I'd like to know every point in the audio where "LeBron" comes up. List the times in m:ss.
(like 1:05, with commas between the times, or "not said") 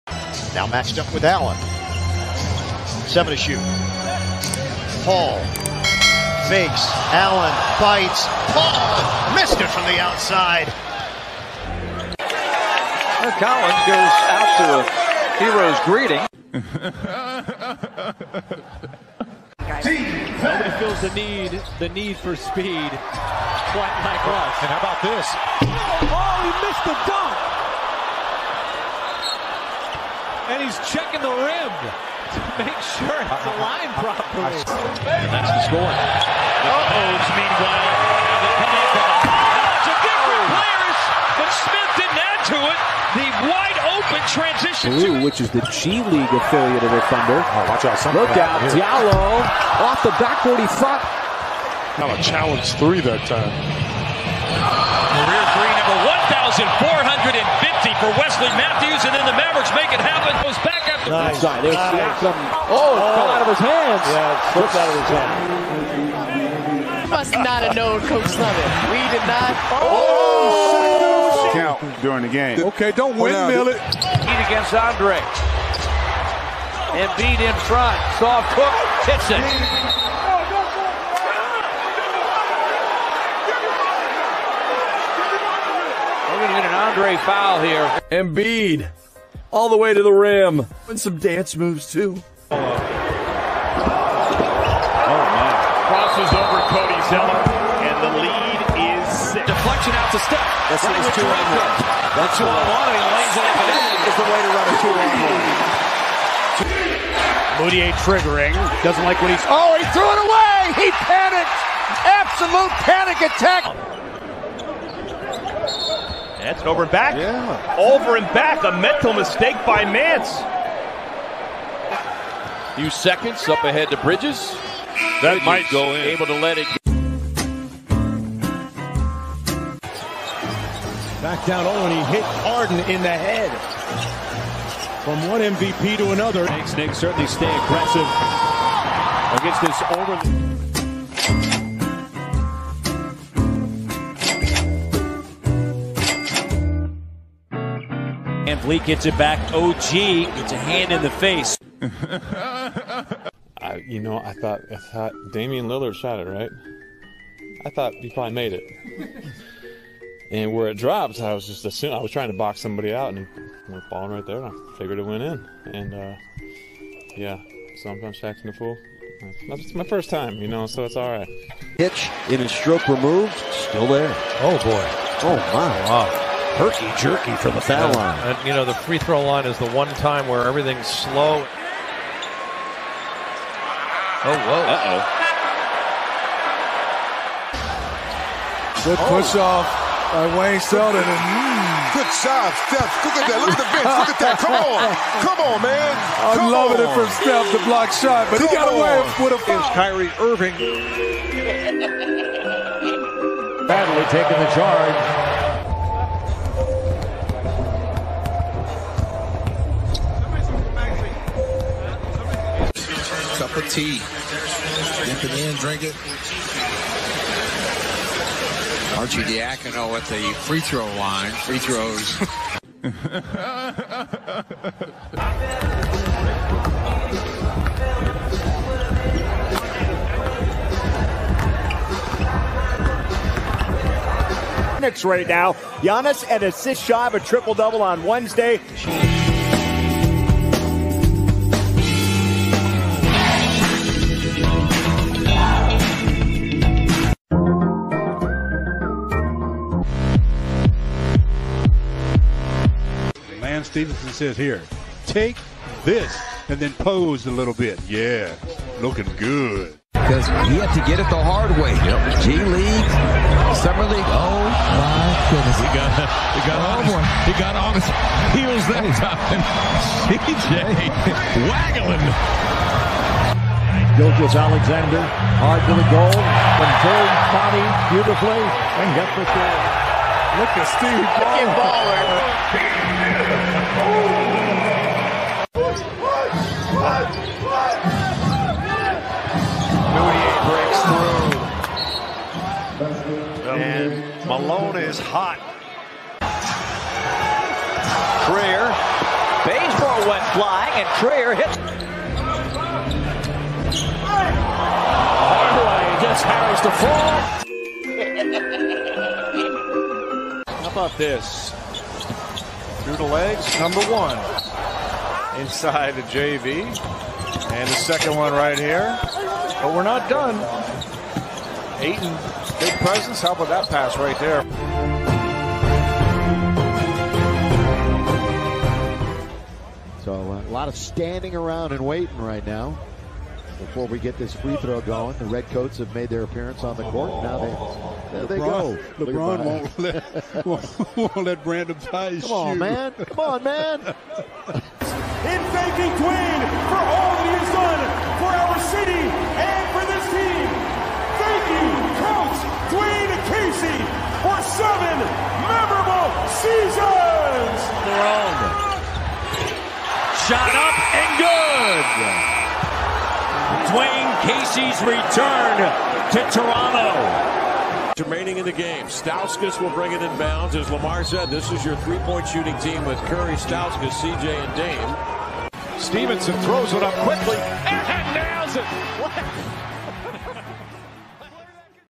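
5:38, 5:57.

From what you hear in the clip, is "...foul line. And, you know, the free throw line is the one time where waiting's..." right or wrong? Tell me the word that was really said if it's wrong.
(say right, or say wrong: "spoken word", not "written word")
wrong: "everything", not "waiting".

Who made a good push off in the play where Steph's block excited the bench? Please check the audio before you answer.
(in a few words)
Wayne Selden.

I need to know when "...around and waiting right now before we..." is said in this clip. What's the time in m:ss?
5:31.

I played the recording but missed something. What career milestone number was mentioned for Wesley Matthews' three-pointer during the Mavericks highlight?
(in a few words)
1,450.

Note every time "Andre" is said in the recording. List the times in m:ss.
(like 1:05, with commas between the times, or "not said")
1:14, 1:26.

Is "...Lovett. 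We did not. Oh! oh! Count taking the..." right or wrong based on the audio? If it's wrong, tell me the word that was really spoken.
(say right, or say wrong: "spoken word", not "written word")
wrong: "during", not "taking".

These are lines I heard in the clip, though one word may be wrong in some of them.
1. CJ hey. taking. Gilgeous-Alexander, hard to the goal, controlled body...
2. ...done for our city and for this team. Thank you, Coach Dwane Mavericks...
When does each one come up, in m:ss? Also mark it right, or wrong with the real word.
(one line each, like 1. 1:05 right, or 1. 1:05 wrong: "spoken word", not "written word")
1. 4:30 wrong: "waggling", not "taking"
2. 5:47 wrong: "Casey", not "Mavericks".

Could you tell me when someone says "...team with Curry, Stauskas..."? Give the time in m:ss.
6:12.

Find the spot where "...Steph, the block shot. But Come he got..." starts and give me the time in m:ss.
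3:17.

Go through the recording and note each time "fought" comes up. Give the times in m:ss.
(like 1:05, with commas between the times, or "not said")
0:50.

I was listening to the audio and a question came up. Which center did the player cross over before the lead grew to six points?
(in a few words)
Cody Zeller.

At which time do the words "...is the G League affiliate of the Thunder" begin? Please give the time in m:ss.
0:45.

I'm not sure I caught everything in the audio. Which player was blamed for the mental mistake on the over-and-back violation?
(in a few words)
Mance.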